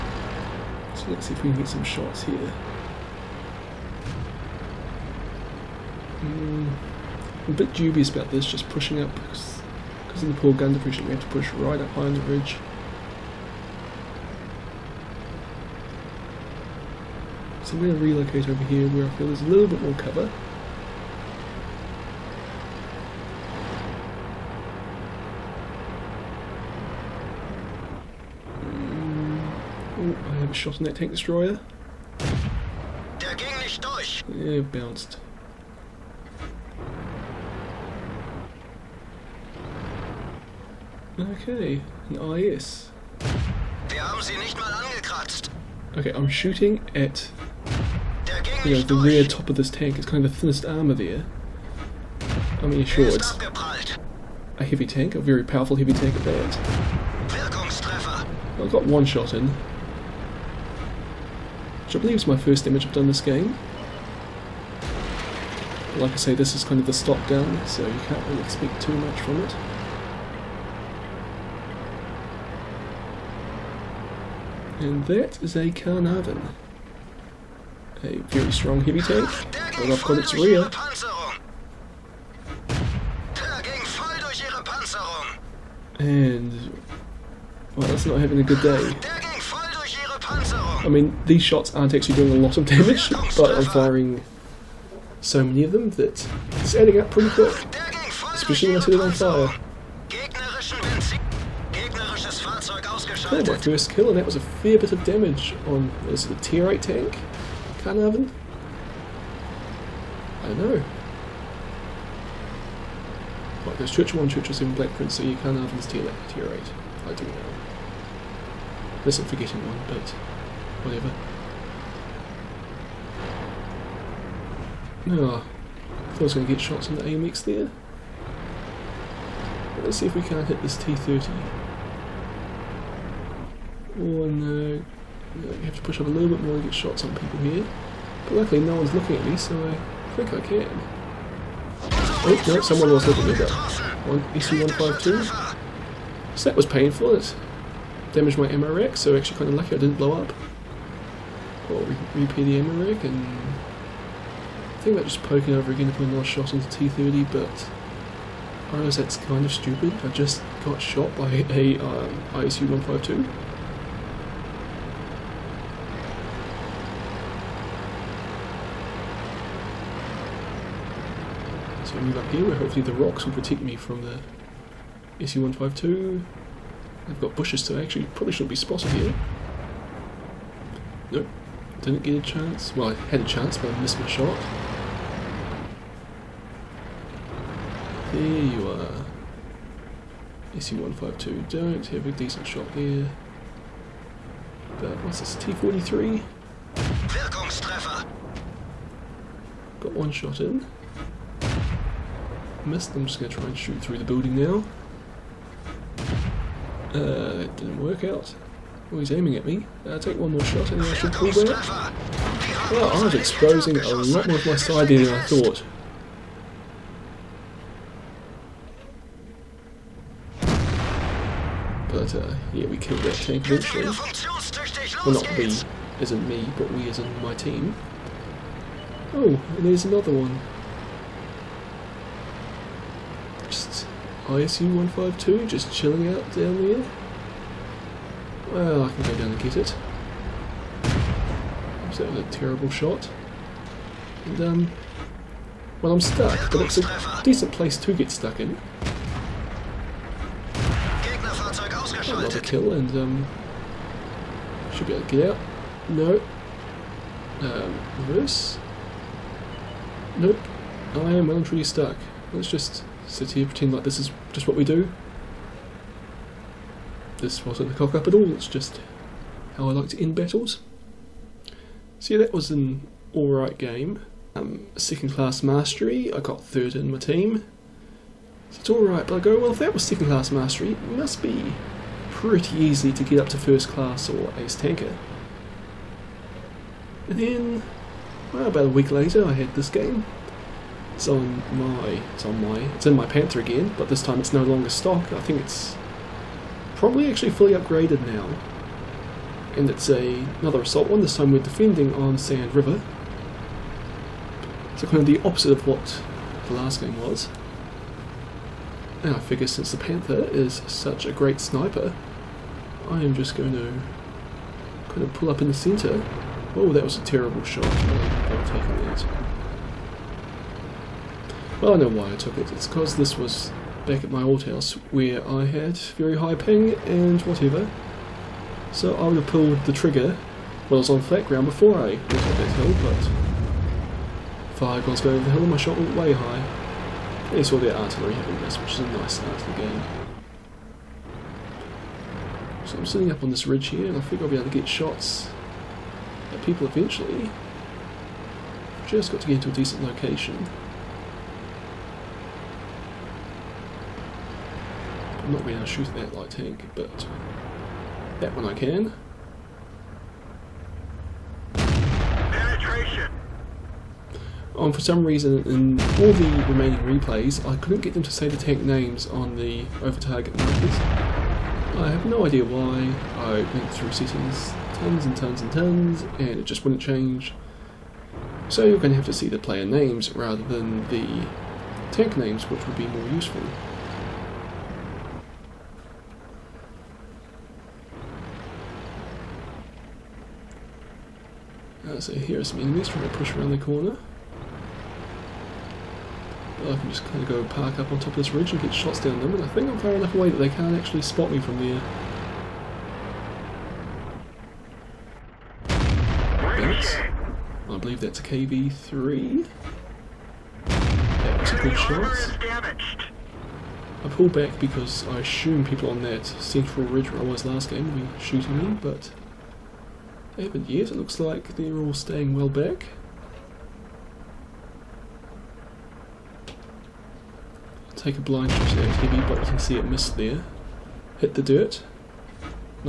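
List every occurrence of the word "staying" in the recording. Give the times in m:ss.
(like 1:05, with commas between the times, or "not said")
7:01.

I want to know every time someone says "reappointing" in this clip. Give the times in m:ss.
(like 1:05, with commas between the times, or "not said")
not said.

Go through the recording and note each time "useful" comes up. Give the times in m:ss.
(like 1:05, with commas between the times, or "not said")
6:23.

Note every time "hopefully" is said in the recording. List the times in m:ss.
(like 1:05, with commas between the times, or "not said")
2:52.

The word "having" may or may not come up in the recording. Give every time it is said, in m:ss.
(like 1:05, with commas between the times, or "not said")
1:28, 5:38.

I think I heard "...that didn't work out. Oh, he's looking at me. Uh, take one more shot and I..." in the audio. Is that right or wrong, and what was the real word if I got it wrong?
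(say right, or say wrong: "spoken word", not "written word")
wrong: "aiming", not "looking".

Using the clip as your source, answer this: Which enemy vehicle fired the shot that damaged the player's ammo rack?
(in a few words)
EC152.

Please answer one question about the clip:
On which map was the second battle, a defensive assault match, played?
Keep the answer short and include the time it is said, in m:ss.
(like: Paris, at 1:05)
Sand River, at 5:02.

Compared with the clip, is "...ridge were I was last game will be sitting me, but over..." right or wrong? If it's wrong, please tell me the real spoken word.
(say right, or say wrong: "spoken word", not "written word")
wrong: "shooting", not "sitting".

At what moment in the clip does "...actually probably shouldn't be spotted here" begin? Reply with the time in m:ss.
2:57.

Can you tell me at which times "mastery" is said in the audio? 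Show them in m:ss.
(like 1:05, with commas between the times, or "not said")
4:35, 4:40.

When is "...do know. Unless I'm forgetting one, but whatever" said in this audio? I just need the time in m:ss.
1:57.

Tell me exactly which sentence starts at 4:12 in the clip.
Another kill, and um, should be able to get out.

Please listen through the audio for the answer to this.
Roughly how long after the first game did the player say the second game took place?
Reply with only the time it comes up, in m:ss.
4:48.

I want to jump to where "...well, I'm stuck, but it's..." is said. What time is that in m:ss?
4:05.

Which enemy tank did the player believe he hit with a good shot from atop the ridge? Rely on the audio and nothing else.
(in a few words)
KV-3.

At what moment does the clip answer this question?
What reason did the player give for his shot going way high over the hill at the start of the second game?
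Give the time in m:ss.
5:25.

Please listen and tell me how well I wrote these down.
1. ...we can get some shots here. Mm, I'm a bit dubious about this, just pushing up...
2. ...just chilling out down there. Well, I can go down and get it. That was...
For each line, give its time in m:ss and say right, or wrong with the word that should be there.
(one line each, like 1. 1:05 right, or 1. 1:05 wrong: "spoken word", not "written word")
1. 0:01 right
2. 3:55 right.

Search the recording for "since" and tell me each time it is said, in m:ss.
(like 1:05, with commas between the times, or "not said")
5:09.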